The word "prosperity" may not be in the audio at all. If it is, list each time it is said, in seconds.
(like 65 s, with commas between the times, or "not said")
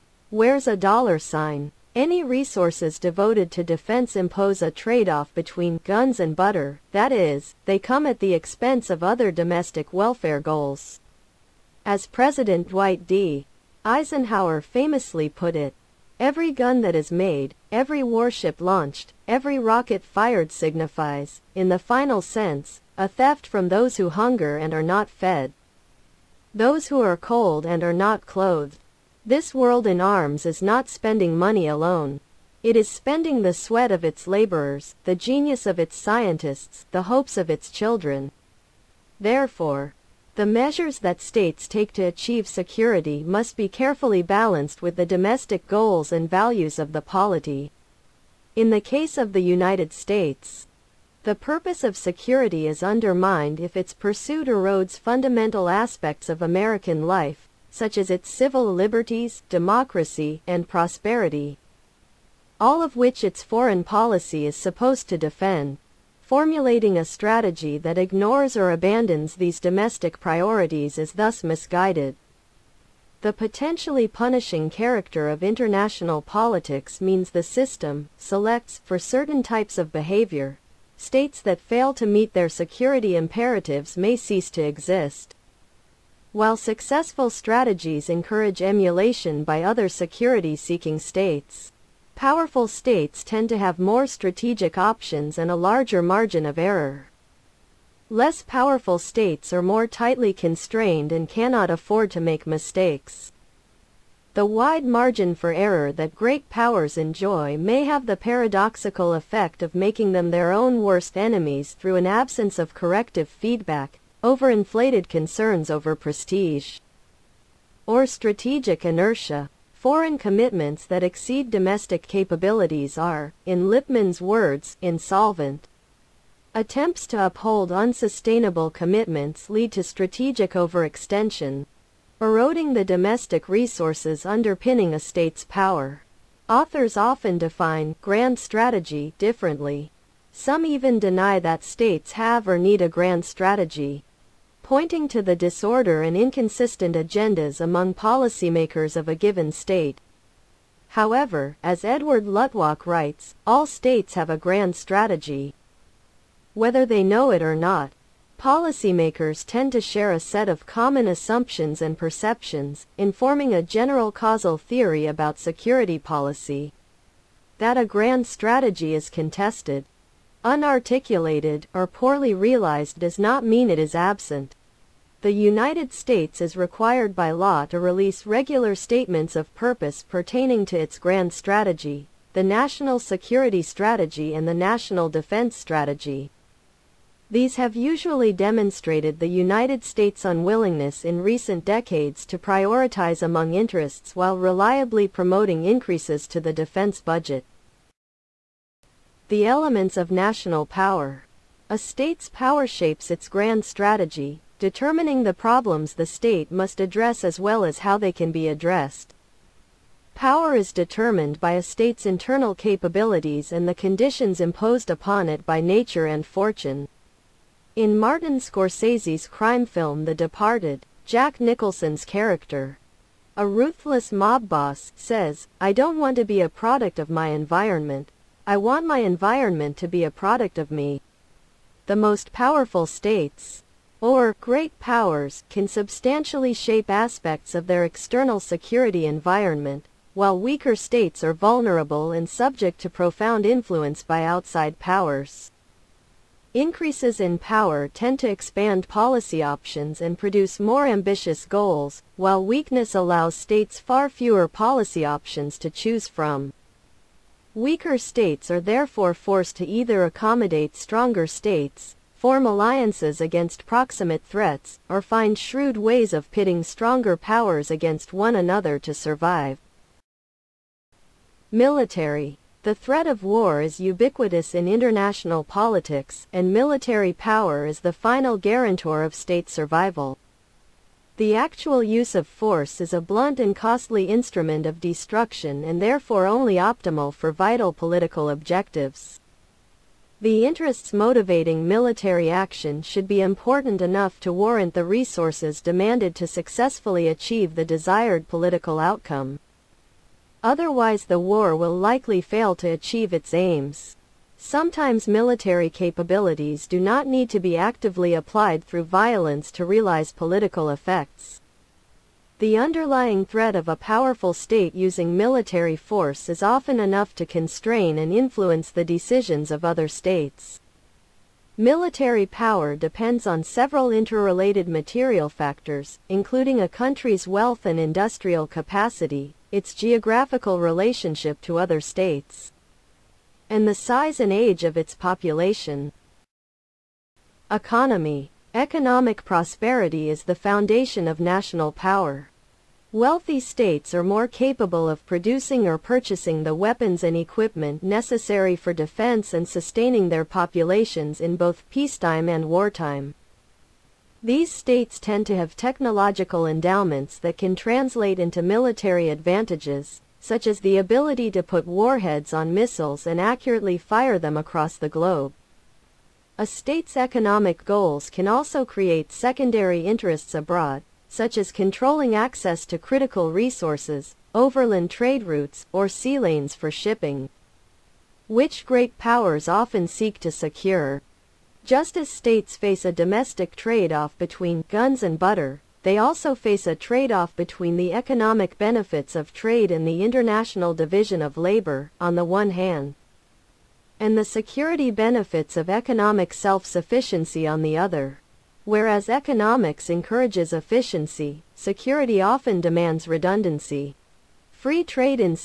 60 s, 339 s.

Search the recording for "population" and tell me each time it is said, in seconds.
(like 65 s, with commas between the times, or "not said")
334 s, 350 s.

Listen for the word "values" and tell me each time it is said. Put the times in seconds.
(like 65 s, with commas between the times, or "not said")
46 s.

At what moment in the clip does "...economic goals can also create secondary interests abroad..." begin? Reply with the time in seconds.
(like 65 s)
366 s.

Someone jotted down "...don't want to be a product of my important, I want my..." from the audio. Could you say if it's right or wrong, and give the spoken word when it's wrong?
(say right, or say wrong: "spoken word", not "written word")
wrong: "environment", not "important".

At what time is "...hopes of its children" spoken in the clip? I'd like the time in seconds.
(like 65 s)
37 s.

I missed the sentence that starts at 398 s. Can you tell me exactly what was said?
Whereas economics encourages efficiency, security often demands redundancy.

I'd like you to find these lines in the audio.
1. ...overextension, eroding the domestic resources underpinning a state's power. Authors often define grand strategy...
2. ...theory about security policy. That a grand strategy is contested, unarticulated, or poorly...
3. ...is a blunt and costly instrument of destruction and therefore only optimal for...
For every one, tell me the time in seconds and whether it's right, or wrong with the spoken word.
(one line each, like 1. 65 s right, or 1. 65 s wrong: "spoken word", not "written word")
1. 130 s right
2. 164 s right
3. 282 s right.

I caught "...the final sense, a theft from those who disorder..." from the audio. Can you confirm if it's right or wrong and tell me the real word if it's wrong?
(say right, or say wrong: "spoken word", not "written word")
wrong: "hunger", not "disorder".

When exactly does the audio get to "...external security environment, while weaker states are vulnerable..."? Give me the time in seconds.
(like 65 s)
237 s.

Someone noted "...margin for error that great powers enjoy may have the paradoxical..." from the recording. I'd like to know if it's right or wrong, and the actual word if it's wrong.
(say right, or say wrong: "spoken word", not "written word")
right.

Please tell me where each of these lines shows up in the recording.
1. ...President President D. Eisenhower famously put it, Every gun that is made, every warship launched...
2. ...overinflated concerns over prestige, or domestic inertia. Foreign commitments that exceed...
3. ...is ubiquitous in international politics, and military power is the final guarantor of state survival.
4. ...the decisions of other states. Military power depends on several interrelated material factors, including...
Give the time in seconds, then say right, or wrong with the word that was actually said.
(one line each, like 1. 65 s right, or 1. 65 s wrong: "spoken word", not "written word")
1. 12 s wrong: "Dwight", not "President"
2. 114 s wrong: "strategic", not "domestic"
3. 273 s right
4. 318 s right.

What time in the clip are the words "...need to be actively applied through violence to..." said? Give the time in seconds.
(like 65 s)
307 s.